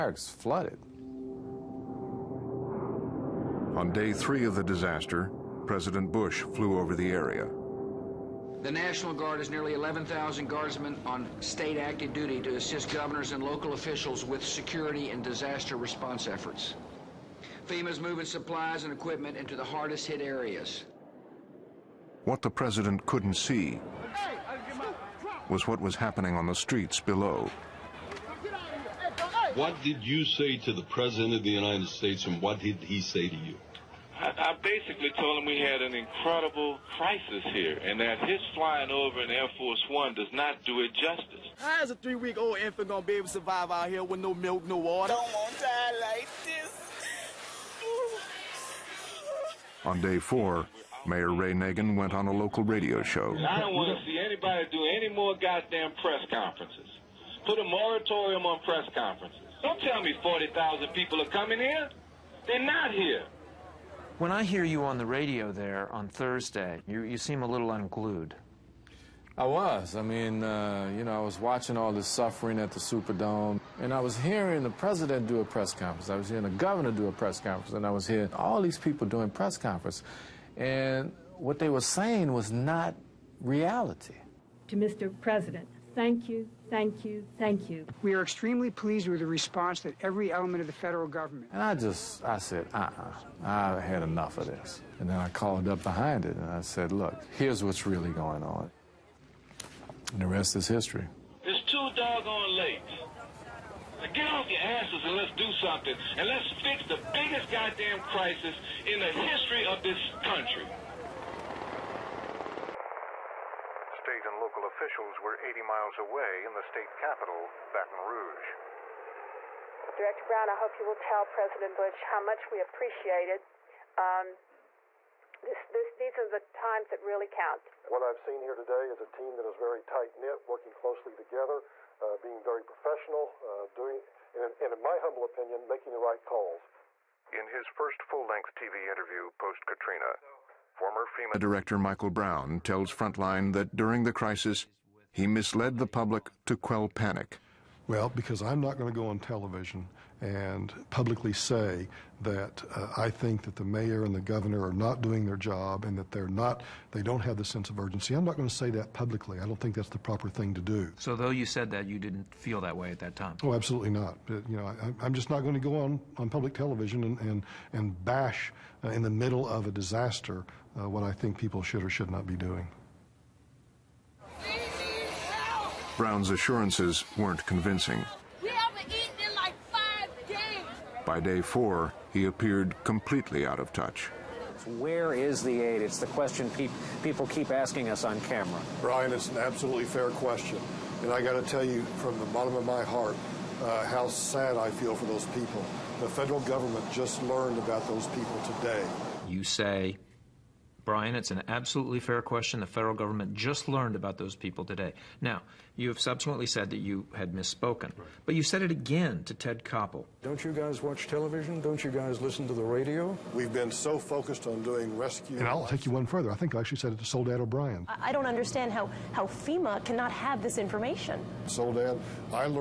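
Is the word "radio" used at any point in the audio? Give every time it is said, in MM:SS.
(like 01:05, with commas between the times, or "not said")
00:52, 01:05, 03:32.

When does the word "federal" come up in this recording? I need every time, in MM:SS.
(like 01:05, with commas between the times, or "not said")
01:30, 03:16, 03:22.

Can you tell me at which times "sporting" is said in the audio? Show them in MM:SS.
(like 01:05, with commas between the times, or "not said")
not said.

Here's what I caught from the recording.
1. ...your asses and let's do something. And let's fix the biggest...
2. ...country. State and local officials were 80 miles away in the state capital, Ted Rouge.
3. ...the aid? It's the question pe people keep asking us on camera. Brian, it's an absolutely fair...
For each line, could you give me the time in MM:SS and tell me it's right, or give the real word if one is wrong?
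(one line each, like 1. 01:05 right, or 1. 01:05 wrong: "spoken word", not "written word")
1. 01:44 right
2. 01:50 wrong: "Baton", not "Ted"
3. 03:05 right.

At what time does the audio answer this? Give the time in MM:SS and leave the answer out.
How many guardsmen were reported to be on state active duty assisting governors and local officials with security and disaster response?
00:09.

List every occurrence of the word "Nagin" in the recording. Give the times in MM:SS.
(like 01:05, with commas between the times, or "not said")
00:51.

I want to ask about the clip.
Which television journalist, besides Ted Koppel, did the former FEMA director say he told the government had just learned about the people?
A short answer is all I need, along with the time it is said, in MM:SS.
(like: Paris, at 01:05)
Soledad O'Brien, at 03:37.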